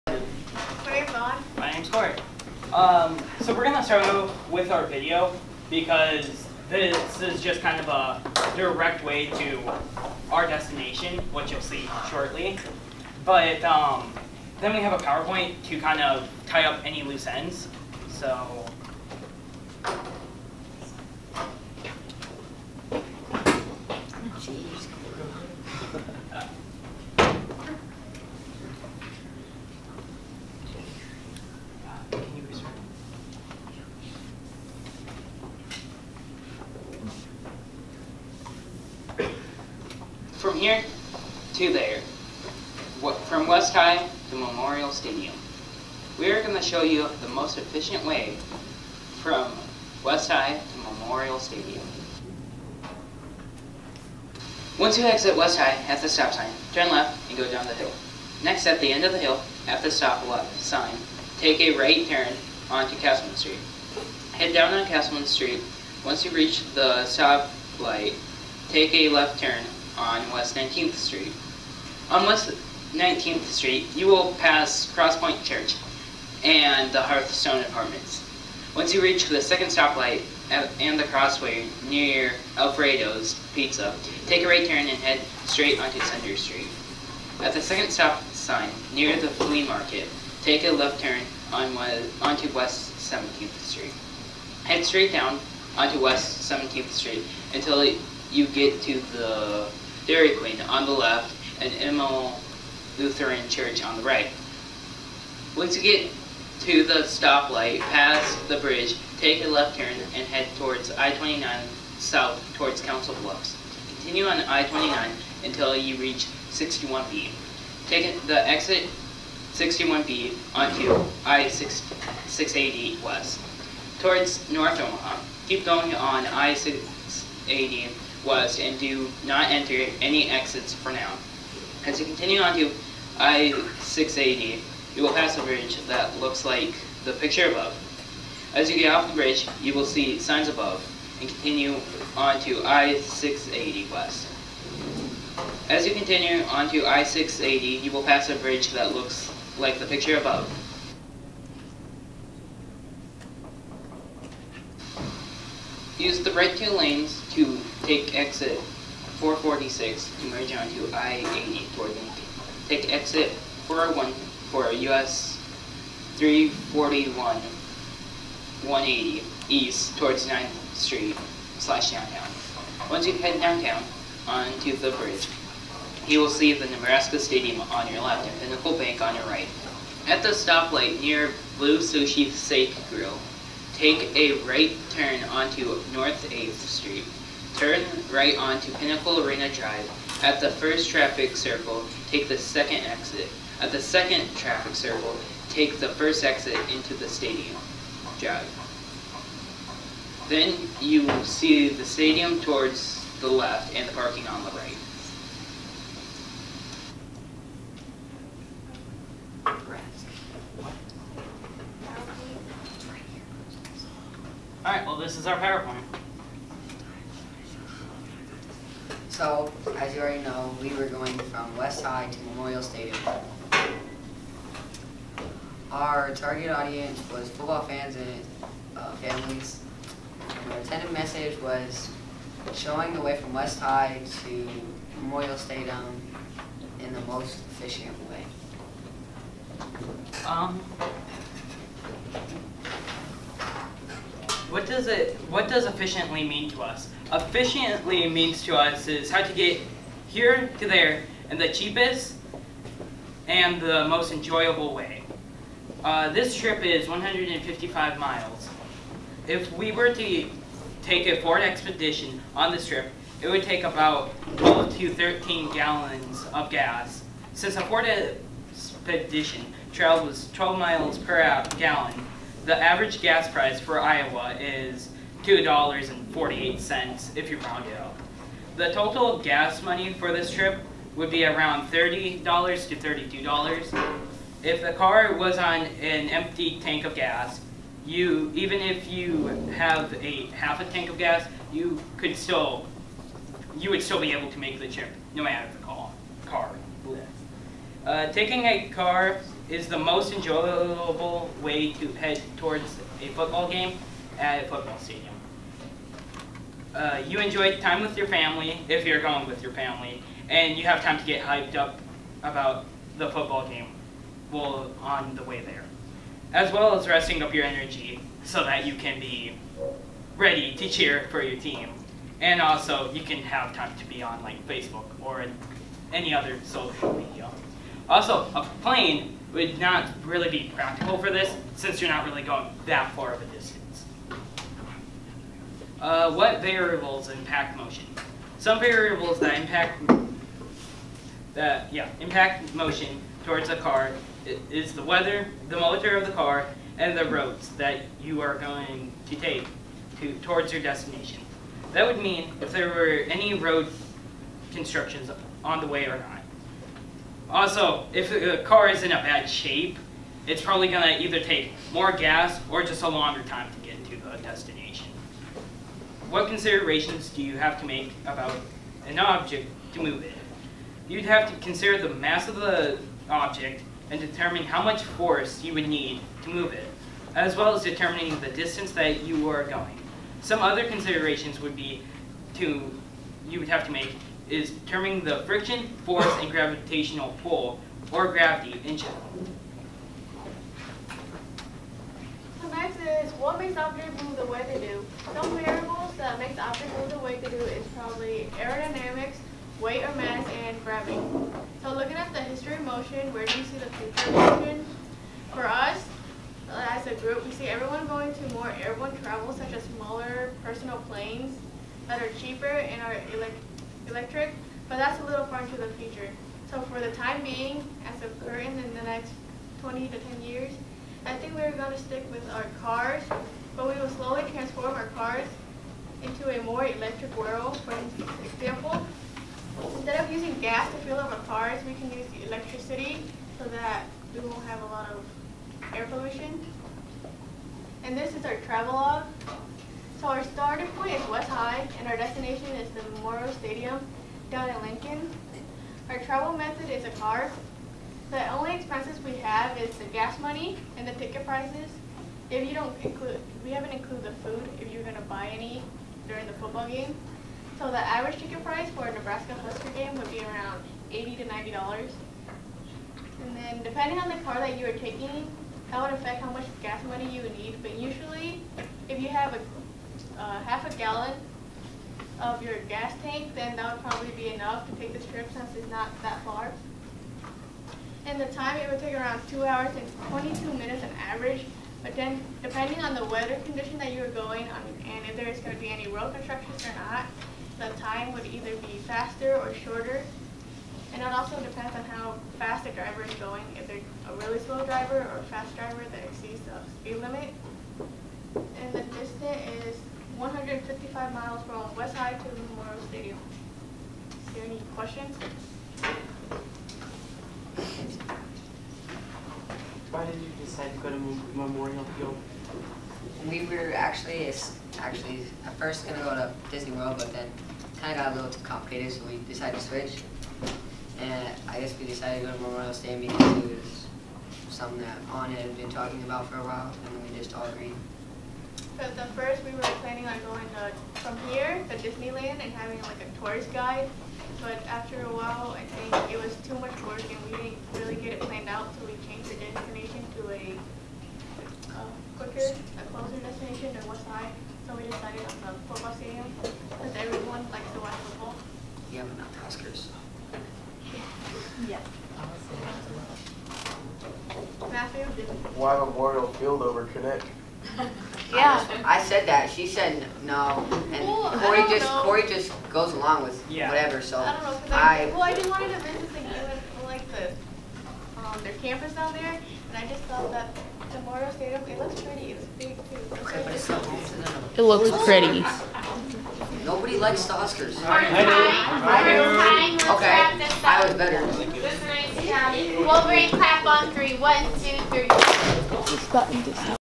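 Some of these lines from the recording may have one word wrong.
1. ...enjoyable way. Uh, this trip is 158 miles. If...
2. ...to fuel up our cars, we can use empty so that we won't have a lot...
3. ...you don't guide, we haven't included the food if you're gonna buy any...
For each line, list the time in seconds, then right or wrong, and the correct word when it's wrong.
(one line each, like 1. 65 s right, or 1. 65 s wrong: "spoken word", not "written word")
1. 254 s wrong: "155", not "158"
2. 430 s wrong: "electricity", not "empty"
3. 452 s wrong: "include", not "guide".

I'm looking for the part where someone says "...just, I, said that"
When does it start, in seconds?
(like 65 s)
558 s.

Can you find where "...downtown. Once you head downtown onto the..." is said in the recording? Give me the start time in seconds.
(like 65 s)
171 s.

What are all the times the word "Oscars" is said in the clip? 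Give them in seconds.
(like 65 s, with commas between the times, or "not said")
549 s, 577 s.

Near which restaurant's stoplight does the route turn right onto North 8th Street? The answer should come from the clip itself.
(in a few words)
Blue Sushi Sake Grill.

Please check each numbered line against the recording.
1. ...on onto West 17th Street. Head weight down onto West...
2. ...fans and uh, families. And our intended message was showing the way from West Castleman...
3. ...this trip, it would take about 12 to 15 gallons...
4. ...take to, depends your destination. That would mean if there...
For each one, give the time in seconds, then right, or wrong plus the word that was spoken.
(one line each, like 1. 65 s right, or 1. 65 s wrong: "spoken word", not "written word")
1. 91 s wrong: "straight", not "weight"
2. 227 s wrong: "High", not "Castleman"
3. 262 s wrong: "13", not "15"
4. 349 s wrong: "towards", not "depends".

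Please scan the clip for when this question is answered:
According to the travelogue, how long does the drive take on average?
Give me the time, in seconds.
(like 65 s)
479 s.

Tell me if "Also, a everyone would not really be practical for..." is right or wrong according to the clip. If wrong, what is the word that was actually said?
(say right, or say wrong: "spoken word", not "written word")
wrong: "plane", not "everyone".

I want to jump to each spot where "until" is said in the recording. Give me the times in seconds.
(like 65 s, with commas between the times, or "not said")
97 s, 115 s.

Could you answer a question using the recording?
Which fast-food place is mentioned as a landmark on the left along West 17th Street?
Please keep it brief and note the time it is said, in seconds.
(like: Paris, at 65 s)
Dairy Queen, at 100 s.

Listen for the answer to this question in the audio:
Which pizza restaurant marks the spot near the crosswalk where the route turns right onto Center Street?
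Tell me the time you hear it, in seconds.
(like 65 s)
82 s.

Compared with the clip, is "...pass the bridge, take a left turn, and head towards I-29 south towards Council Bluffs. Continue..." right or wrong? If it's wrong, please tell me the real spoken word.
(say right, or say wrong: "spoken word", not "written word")
right.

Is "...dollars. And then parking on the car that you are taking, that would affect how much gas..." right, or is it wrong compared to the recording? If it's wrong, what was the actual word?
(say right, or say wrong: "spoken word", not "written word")
wrong: "depending", not "parking".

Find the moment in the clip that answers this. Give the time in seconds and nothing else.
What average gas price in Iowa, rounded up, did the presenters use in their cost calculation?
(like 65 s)
275 s.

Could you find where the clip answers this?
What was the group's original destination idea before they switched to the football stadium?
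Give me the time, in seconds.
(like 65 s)
516 s.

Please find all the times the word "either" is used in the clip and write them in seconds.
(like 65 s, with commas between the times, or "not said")
361 s, 488 s.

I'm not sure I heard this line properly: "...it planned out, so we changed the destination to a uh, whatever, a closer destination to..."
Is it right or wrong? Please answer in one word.
wrong.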